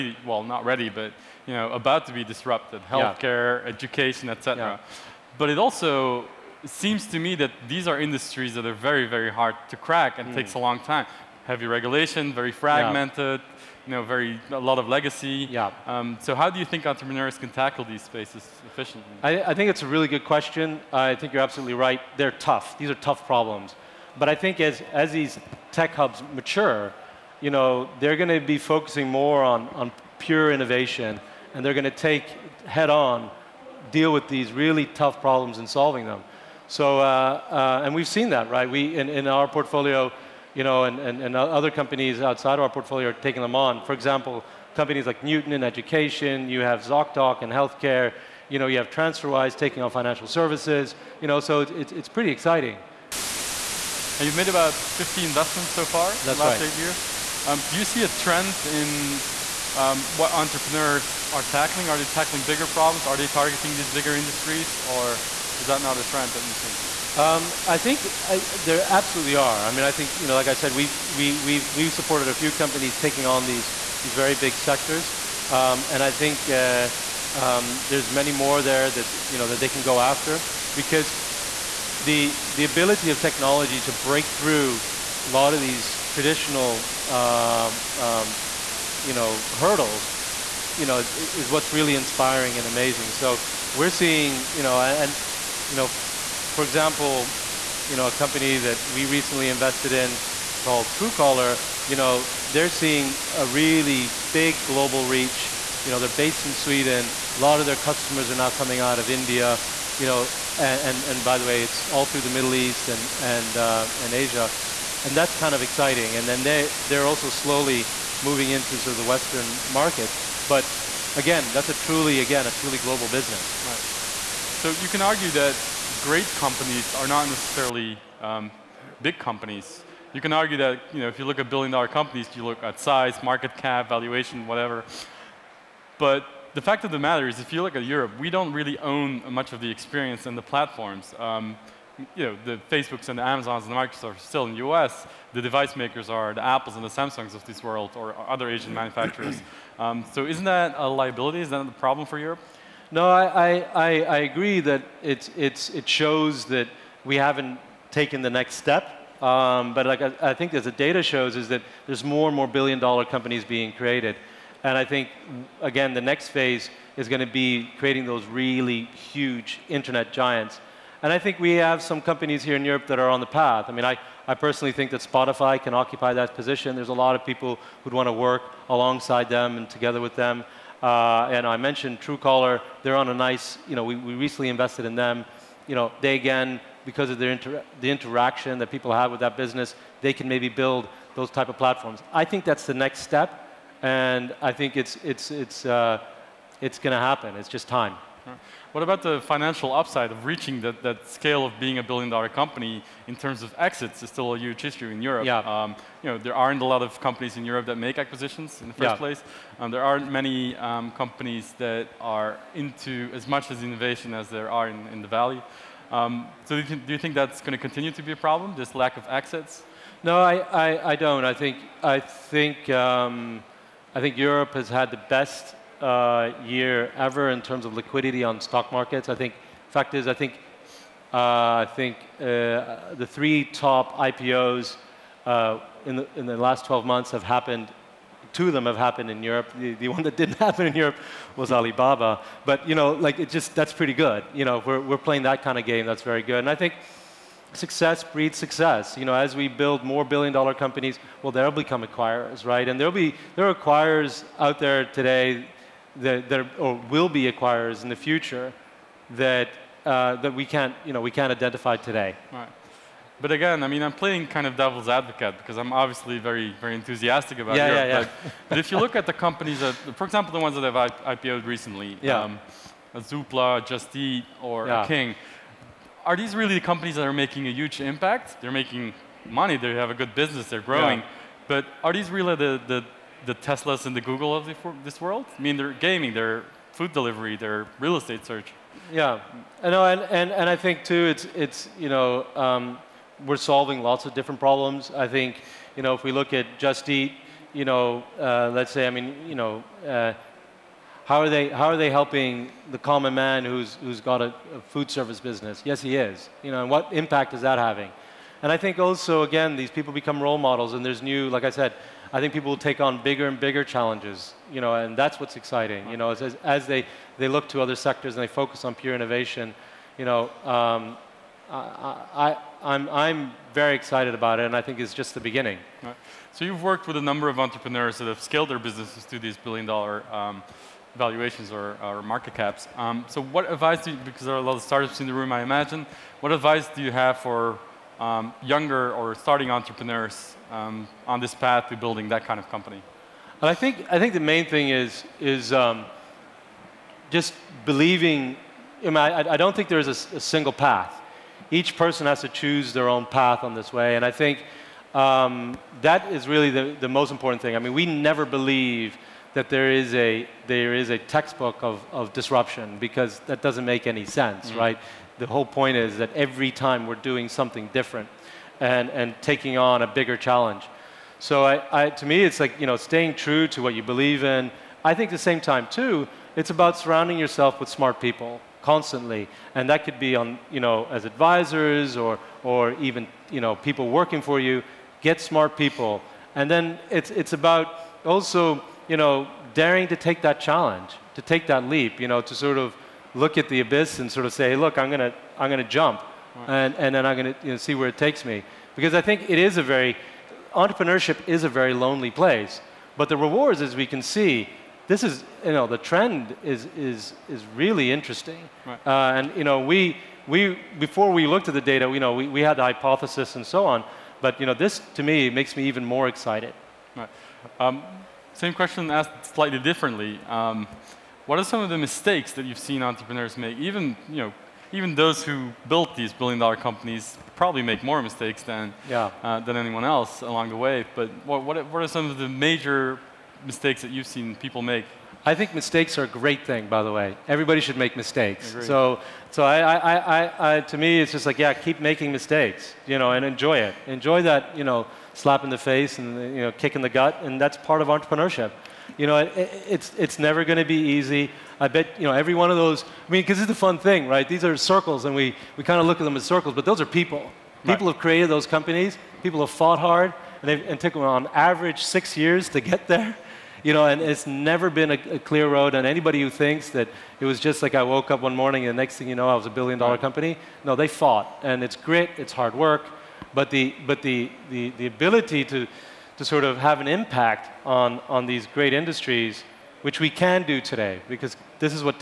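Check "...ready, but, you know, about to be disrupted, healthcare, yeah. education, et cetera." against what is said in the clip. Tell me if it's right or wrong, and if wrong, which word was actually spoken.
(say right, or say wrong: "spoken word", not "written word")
right.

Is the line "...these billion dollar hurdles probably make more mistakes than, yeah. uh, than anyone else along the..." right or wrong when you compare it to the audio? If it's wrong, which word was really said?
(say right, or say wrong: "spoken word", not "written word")
wrong: "companies", not "hurdles".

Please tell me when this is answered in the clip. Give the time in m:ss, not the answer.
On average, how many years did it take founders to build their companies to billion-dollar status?
7:41.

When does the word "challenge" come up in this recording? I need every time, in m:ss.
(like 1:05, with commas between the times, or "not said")
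5:13, 6:10, 6:30.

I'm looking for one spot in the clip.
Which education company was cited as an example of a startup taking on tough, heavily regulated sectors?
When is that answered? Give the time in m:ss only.
0:45.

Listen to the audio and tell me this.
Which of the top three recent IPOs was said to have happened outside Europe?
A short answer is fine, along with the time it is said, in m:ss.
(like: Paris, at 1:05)
Alibaba, at 4:01.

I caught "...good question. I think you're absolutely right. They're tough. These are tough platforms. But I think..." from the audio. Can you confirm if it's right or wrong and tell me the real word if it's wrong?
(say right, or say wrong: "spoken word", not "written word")
wrong: "problems", not "platforms".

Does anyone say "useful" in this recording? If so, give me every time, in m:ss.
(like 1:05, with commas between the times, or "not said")
not said.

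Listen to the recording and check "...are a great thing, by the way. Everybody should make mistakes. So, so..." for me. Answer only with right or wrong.
right.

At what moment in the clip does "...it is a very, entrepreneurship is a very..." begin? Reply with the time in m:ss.
6:39.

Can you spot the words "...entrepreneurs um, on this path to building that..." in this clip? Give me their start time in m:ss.
5:39.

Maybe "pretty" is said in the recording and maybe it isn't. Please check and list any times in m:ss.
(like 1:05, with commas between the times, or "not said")
0:52, 4:03.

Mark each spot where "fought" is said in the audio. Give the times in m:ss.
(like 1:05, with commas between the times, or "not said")
7:39, 7:50.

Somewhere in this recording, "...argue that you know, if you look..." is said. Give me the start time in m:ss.
2:10.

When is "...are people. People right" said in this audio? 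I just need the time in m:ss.
7:36.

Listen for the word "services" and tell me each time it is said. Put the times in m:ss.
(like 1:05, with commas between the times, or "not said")
0:50, 5:04.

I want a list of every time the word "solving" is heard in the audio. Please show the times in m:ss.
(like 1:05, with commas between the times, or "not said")
0:35, 4:53.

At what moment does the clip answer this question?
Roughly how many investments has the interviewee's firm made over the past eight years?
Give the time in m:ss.
0:54.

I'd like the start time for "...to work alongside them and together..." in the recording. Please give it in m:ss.
2:58.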